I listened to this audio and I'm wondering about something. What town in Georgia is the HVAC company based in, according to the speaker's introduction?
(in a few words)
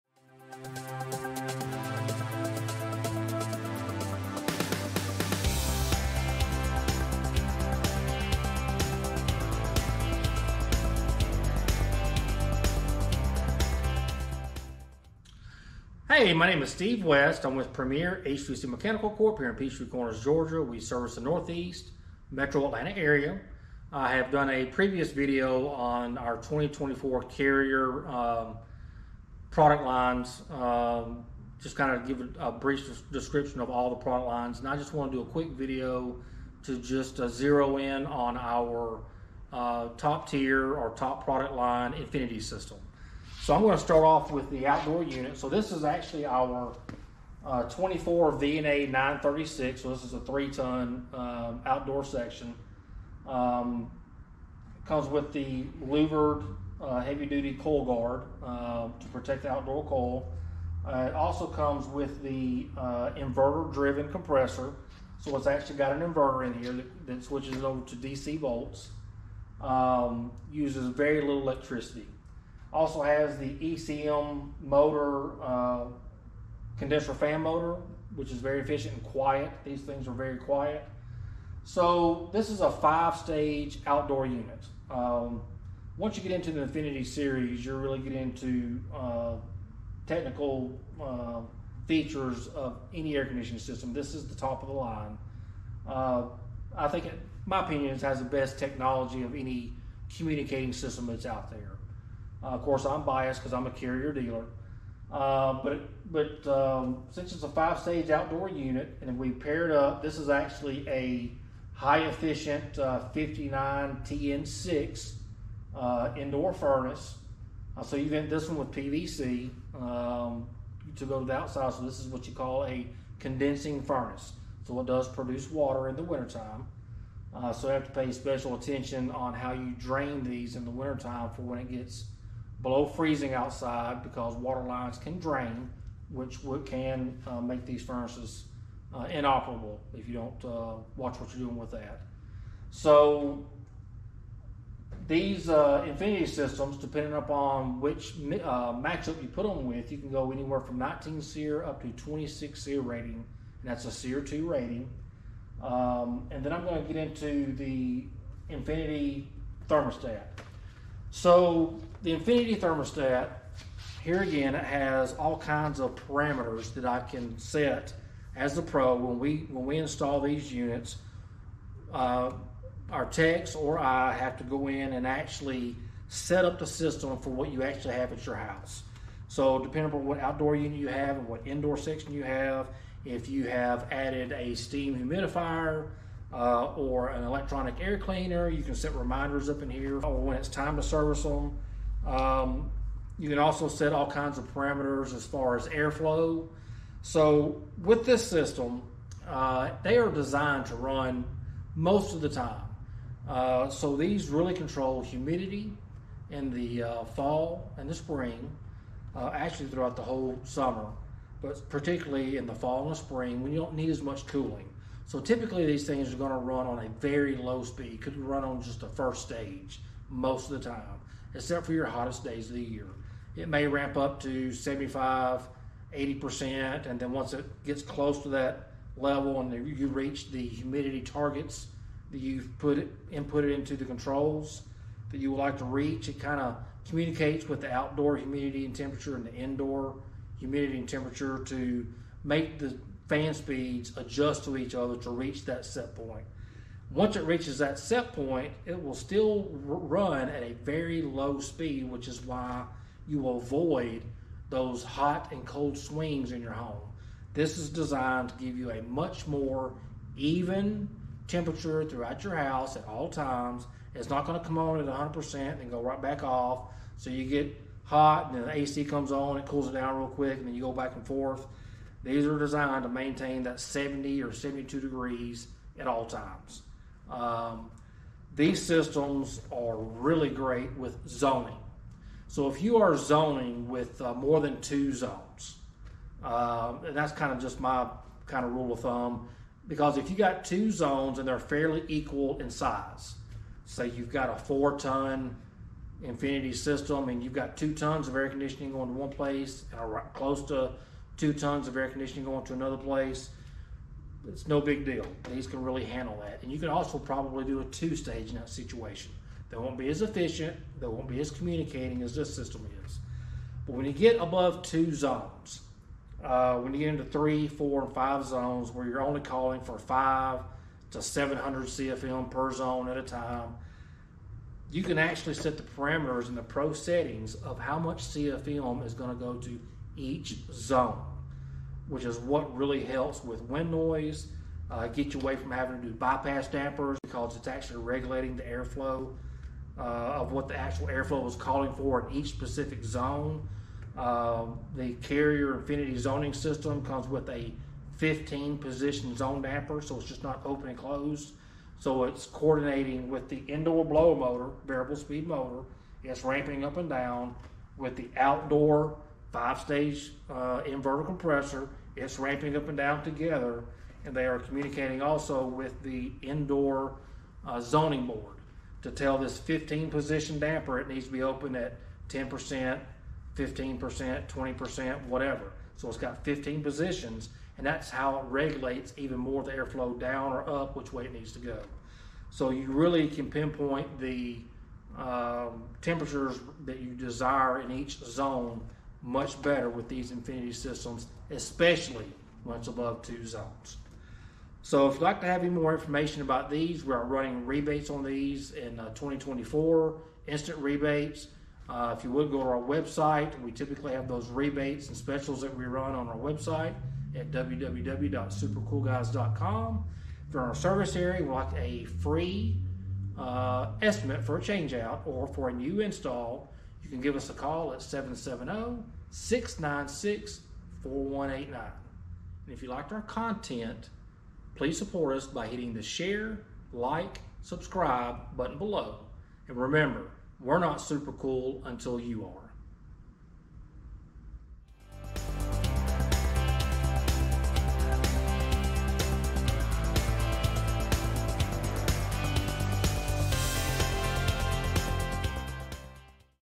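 Peachtree Corners.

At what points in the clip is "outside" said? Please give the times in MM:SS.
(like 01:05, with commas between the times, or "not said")
02:01, 02:13.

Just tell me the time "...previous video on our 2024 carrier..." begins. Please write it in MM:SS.
00:24.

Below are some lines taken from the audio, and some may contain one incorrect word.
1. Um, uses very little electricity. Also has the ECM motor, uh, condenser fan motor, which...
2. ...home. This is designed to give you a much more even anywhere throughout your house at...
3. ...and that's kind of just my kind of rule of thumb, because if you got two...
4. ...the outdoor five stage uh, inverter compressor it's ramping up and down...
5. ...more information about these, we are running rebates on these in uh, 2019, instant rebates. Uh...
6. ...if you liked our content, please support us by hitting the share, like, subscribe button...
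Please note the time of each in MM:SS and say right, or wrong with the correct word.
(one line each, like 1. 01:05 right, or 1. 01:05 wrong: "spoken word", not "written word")
1. 01:09 right
2. 04:16 wrong: "temperature", not "anywhere"
3. 04:46 right
4. 05:57 right
5. 06:35 wrong: "2024", not "2019"
6. 07:02 right.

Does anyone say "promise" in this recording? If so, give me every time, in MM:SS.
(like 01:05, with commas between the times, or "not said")
not said.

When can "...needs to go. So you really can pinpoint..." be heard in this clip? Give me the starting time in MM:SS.
06:21.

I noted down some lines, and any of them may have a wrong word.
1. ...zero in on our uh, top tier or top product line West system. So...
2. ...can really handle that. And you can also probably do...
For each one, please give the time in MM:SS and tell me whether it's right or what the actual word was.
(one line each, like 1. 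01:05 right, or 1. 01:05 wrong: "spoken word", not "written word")
1. 00:37 wrong: "Infinity", not "West"
2. 05:05 right.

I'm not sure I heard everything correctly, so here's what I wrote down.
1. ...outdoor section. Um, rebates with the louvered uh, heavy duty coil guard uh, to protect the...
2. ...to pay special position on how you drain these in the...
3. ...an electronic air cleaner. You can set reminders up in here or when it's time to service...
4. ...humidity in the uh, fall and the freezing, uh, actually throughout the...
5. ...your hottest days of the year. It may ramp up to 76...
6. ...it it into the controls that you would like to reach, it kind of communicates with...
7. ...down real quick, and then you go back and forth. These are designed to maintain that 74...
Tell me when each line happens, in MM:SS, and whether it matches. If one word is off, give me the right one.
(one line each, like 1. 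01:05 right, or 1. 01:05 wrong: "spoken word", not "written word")
1. 00:51 wrong: "comes", not "rebates"
2. 02:07 wrong: "attention", not "position"
3. 03:07 right
4. 03:25 wrong: "spring", not "freezing"
5. 03:41 wrong: "75", not "76"
6. 03:52 right
7. 04:29 wrong: "70", not "74".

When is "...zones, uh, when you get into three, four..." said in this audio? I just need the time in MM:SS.
05:14.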